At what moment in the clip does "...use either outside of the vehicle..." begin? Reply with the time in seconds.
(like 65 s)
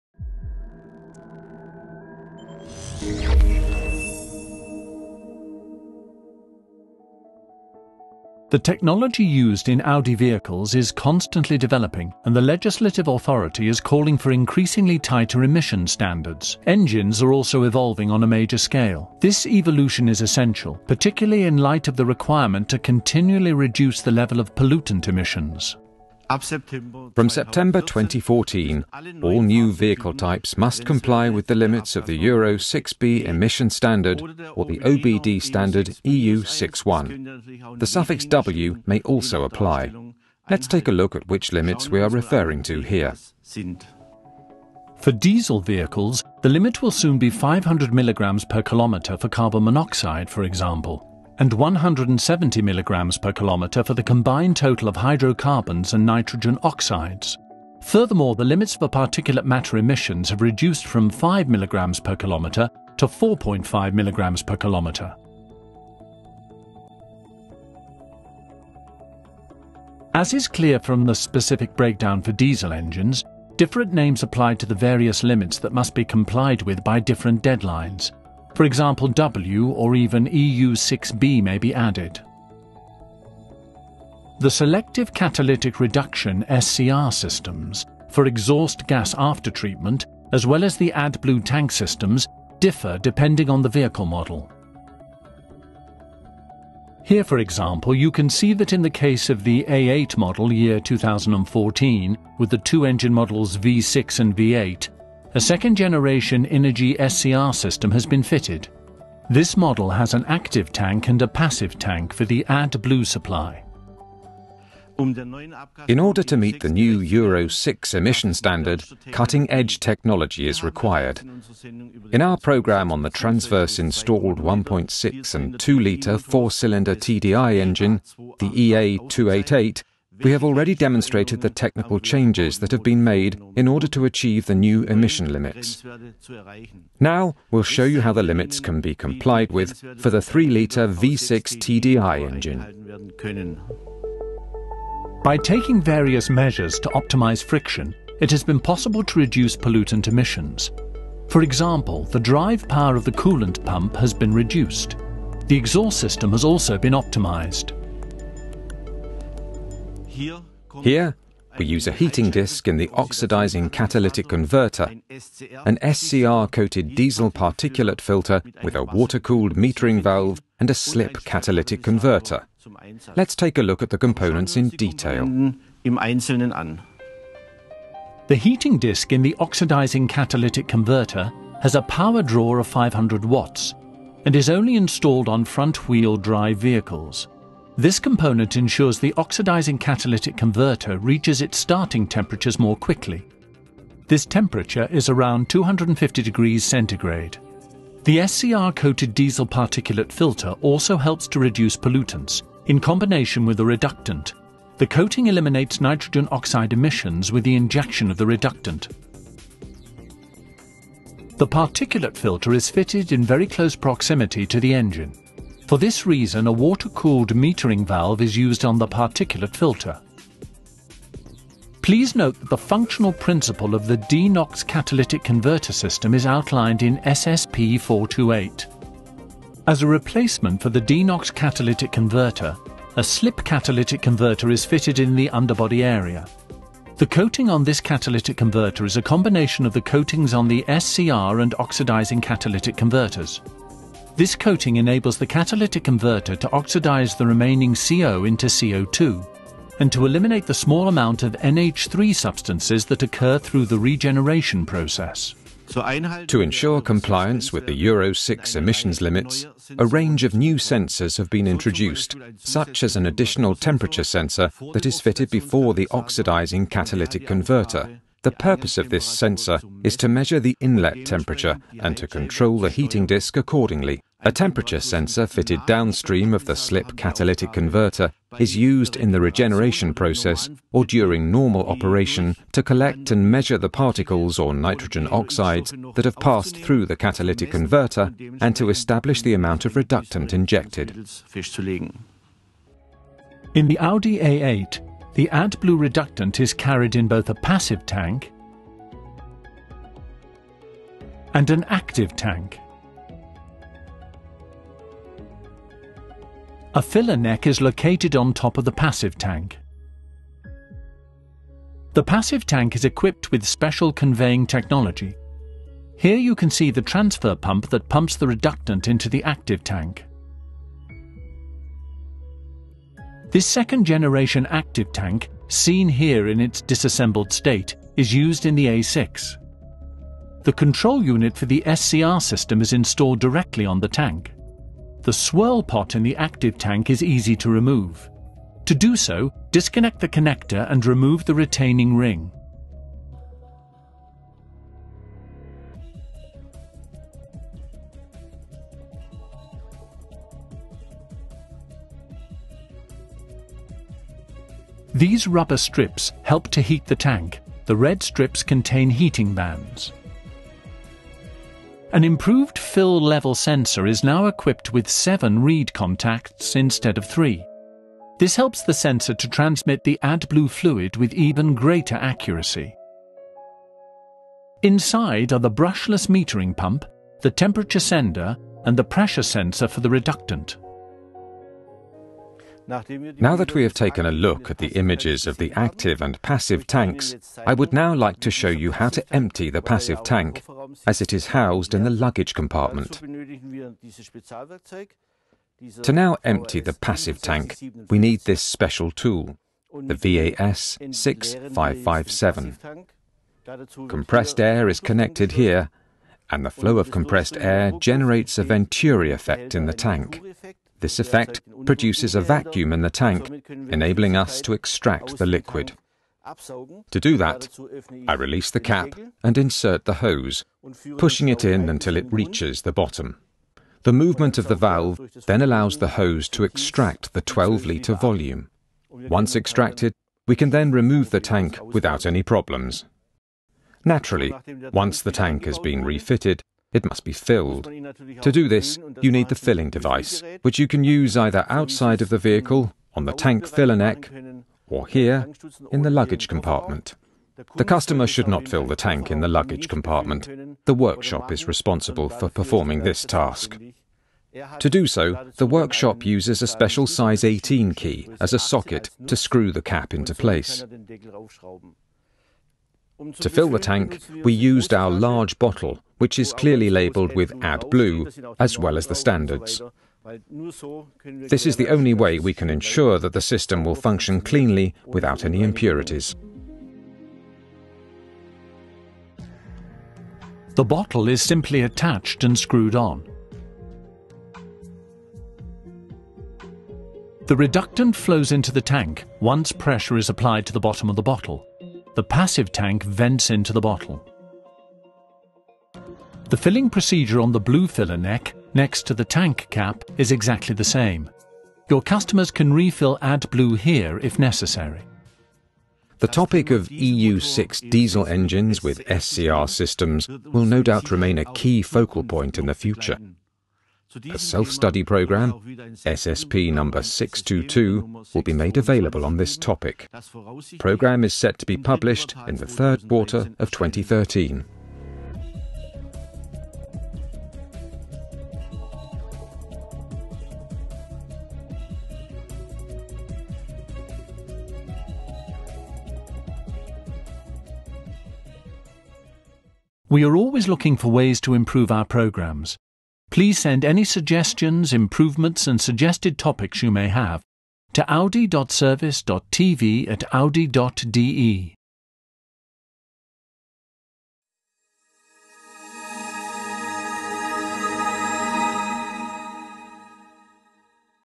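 440 s.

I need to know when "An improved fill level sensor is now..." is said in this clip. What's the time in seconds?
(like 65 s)
361 s.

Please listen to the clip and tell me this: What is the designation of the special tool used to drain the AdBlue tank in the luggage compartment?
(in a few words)
VAS 6557.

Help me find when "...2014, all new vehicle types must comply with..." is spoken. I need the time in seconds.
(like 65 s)
27 s.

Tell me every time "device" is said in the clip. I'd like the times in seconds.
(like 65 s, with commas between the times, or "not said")
439 s.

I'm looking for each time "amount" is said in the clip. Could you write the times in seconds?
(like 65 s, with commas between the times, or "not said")
250 s, 289 s.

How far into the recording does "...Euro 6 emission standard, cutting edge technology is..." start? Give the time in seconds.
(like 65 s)
116 s.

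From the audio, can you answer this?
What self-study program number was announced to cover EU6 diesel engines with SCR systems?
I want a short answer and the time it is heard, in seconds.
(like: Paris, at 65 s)
SSP 622, at 515 s.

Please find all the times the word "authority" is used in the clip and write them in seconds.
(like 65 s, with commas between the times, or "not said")
13 s.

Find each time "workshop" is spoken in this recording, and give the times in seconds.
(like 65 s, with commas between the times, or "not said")
450 s, 455 s.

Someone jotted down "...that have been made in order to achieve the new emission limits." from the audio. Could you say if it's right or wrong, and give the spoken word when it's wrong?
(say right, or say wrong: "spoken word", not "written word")
right.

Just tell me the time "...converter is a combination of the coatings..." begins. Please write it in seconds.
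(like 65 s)
238 s.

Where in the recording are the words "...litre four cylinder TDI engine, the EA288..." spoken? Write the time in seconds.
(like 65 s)
125 s.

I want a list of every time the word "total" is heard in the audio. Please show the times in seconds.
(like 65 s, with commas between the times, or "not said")
54 s.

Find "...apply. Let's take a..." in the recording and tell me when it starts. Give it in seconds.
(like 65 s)
39 s.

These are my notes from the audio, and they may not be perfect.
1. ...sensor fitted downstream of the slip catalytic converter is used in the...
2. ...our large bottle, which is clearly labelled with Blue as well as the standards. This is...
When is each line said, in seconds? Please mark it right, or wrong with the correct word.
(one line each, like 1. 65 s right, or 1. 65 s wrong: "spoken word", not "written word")
1. 274 s right
2. 464 s right.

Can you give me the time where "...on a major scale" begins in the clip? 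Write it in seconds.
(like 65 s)
18 s.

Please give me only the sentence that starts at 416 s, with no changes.
To do that, I release the cap and insert the hose, pushing it in until it reaches the bottom.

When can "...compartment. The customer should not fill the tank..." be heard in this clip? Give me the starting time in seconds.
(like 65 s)
446 s.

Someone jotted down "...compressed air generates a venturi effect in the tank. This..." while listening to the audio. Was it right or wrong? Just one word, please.
right.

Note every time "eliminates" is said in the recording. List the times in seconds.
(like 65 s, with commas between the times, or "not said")
205 s, 250 s.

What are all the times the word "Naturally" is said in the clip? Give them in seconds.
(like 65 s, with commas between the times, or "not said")
433 s.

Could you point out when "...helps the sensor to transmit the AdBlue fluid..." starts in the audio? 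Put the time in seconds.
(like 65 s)
368 s.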